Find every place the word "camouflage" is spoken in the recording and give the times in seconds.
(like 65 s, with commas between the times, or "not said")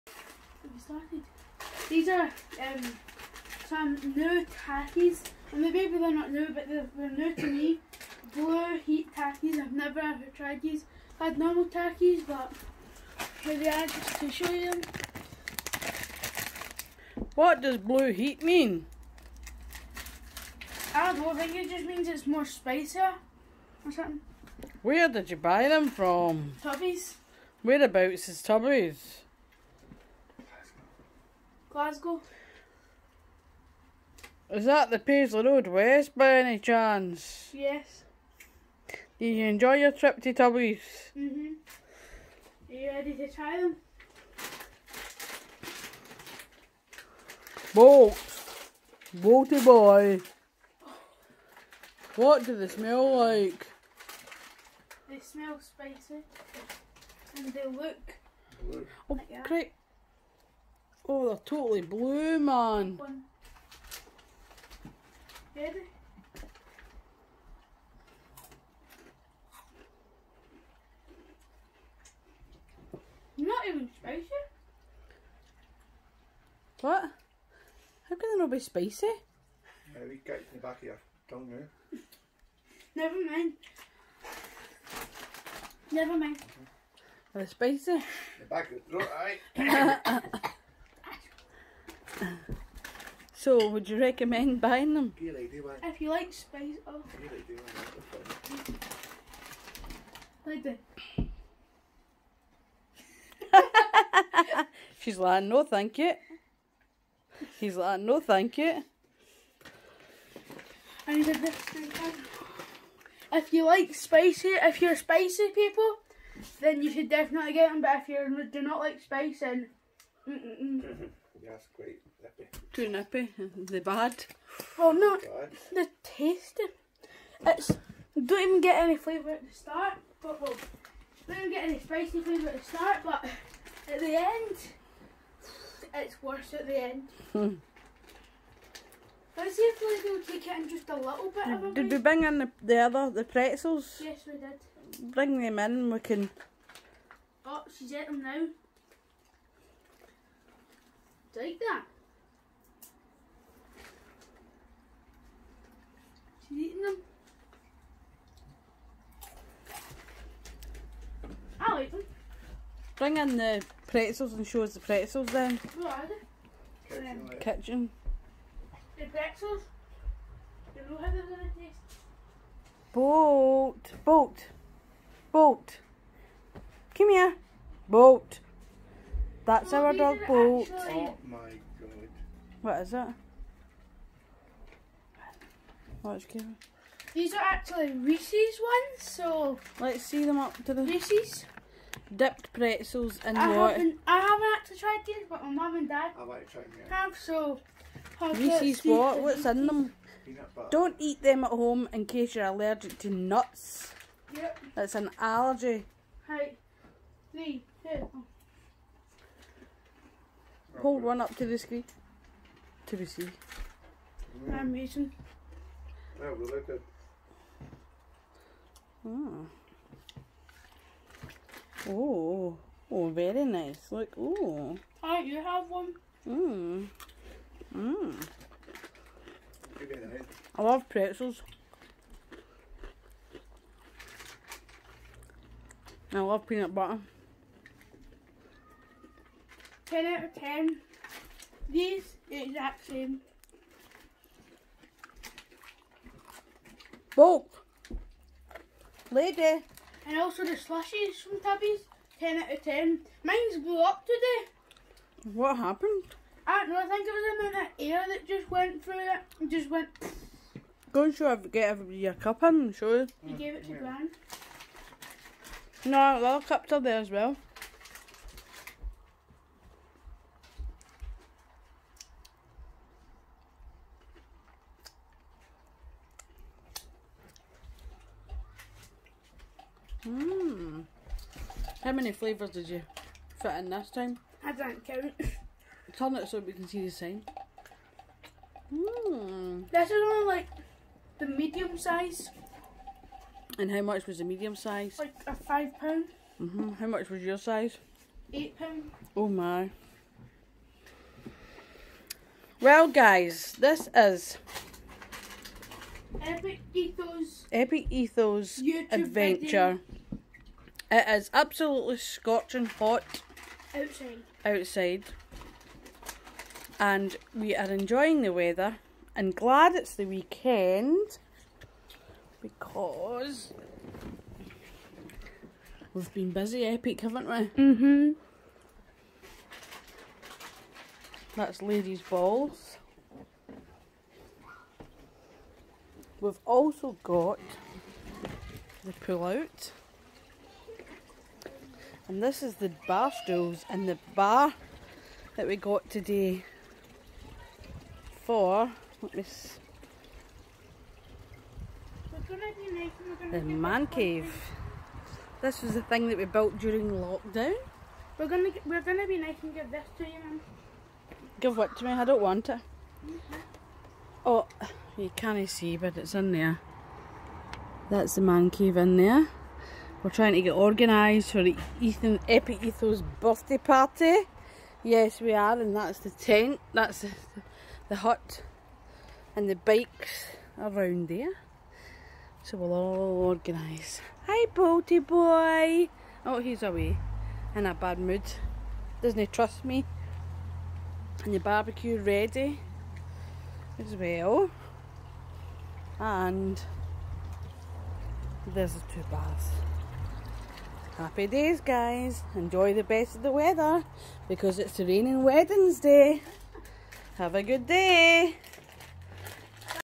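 not said.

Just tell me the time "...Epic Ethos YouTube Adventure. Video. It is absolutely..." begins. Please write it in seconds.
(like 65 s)
307 s.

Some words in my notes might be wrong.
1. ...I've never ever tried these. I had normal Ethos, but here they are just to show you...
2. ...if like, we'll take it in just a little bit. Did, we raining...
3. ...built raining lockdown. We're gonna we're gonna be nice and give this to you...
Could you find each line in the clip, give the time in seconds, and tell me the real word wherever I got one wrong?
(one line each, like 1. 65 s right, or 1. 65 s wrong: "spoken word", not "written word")
1. 9 s wrong: "Takis", not "Ethos"
2. 139 s wrong: "bring", not "raining"
3. 356 s wrong: "during", not "raining".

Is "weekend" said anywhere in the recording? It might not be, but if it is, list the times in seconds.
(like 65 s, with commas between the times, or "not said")
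320 s.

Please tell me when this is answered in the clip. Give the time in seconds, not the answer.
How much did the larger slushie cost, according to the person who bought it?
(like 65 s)
298 s.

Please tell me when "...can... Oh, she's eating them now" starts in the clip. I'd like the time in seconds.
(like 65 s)
146 s.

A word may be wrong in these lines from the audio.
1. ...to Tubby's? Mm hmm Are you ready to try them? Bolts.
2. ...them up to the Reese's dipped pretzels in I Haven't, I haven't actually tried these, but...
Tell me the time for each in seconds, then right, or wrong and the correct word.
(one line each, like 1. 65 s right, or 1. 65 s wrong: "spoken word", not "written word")
1. 40 s right
2. 190 s right.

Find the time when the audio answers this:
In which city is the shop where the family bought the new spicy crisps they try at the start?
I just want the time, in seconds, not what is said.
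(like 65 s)
31 s.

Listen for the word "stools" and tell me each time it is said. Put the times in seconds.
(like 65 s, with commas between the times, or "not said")
343 s.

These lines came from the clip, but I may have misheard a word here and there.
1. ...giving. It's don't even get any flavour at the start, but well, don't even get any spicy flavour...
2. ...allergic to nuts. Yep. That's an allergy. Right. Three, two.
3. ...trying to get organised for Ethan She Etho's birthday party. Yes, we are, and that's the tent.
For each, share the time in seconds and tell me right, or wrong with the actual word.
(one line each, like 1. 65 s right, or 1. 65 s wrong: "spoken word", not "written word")
1. 126 s wrong: "tasting", not "giving"
2. 202 s right
3. 370 s wrong: "Epi", not "She".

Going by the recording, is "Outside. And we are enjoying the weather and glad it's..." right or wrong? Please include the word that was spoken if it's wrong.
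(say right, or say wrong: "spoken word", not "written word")
right.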